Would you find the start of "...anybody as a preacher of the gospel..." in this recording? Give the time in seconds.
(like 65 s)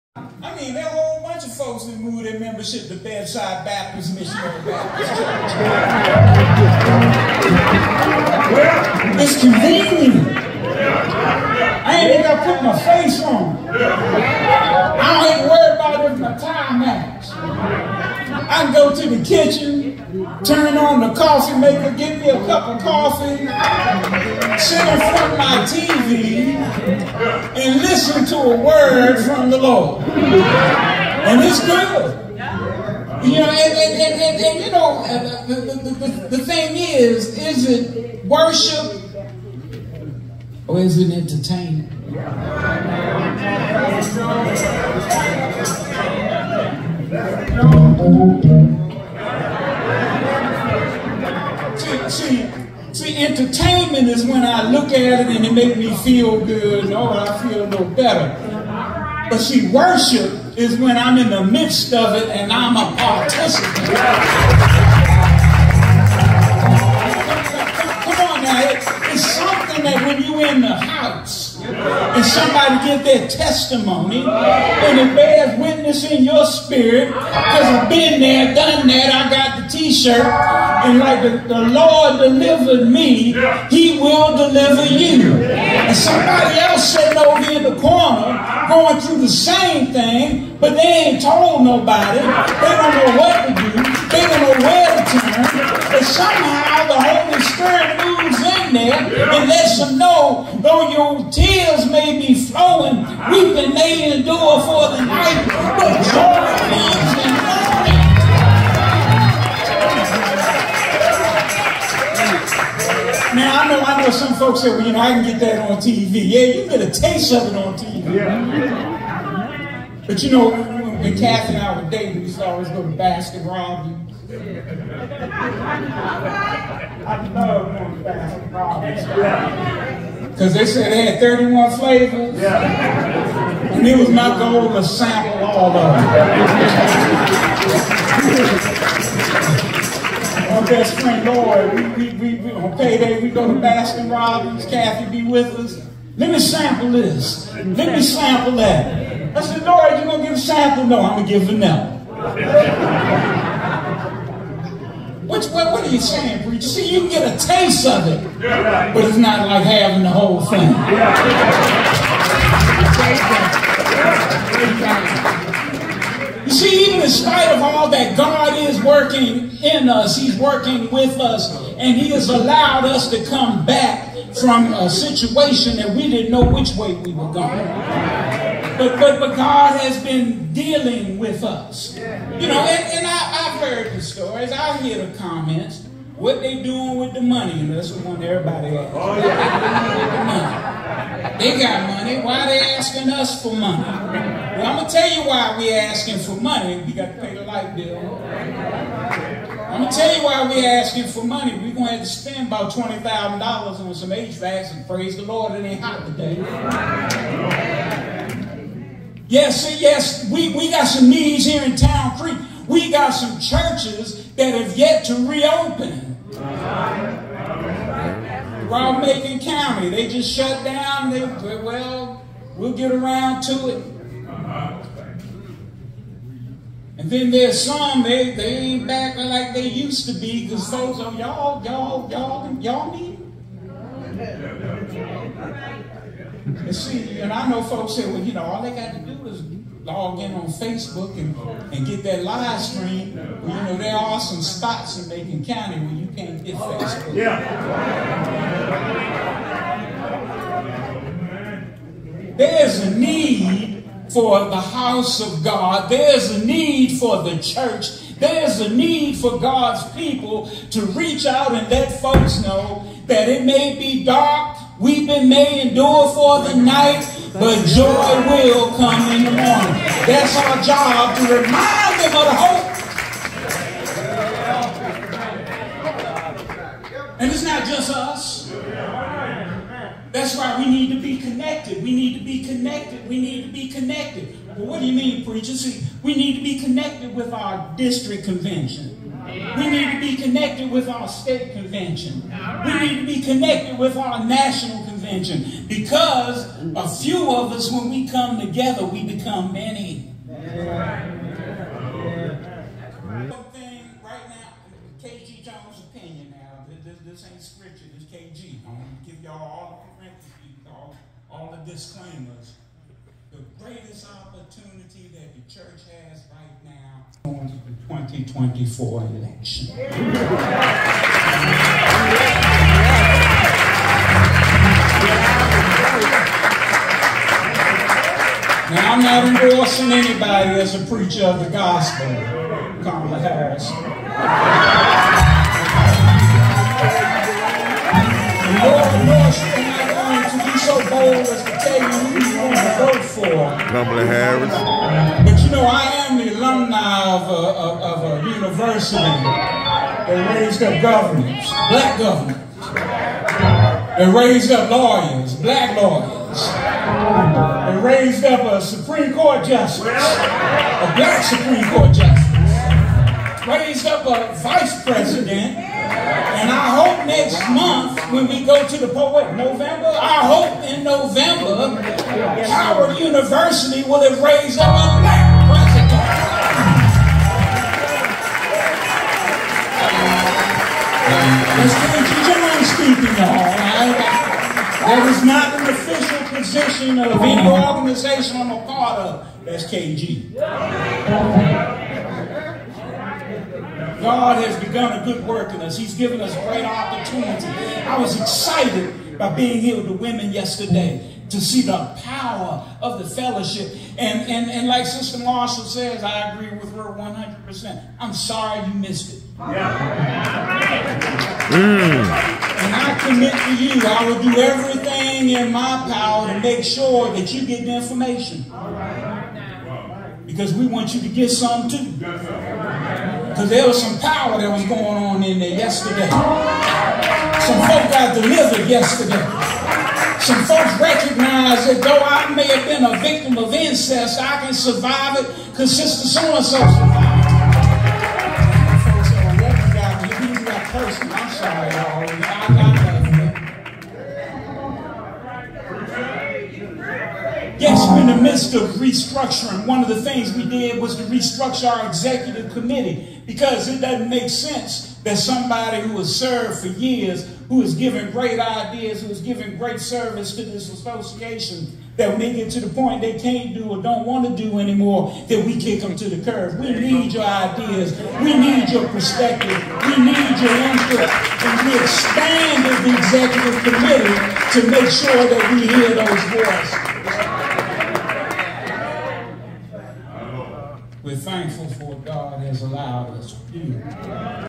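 329 s.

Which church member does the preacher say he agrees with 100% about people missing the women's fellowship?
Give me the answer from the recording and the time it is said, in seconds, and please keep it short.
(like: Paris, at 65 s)
Sister Marshall, at 404 s.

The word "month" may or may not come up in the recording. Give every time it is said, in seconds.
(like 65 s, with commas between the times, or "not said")
367 s.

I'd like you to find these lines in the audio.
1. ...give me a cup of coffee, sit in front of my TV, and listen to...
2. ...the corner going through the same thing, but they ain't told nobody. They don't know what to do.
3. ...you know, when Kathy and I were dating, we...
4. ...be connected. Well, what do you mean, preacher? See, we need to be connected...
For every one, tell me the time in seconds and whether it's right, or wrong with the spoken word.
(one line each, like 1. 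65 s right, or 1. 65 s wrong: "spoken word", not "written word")
1. 21 s right
2. 87 s right
3. 120 s right
4. 283 s right.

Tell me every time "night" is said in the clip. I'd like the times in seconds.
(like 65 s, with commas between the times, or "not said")
105 s, 266 s.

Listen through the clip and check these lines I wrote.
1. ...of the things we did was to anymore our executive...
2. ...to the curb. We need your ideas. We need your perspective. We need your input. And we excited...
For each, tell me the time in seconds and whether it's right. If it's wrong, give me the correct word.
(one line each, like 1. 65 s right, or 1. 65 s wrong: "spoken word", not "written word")
1. 449 s wrong: "restructure", not "anymore"
2. 465 s wrong: "expanded", not "excited".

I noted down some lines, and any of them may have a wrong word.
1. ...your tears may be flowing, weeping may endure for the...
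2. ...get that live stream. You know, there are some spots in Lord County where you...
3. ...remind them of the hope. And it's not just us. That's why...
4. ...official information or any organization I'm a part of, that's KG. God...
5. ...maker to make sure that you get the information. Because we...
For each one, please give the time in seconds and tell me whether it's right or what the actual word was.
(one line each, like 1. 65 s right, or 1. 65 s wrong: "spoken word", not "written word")
1. 100 s right
2. 241 s wrong: "Macon", not "Lord"
3. 271 s right
4. 385 s wrong: "organization", not "information"
5. 415 s wrong: "power", not "maker".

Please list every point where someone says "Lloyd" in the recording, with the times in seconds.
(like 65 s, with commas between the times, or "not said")
141 s, 149 s.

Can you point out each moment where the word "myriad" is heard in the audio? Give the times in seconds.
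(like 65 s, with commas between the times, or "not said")
not said.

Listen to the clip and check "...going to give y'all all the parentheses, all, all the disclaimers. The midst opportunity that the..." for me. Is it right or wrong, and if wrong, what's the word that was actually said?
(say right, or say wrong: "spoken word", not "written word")
wrong: "greatest", not "midst".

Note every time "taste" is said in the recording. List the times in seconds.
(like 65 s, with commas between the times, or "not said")
116 s, 157 s.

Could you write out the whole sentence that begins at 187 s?
And that's what one everybody asks.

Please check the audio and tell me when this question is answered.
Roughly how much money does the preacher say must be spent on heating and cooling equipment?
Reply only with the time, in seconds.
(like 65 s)
202 s.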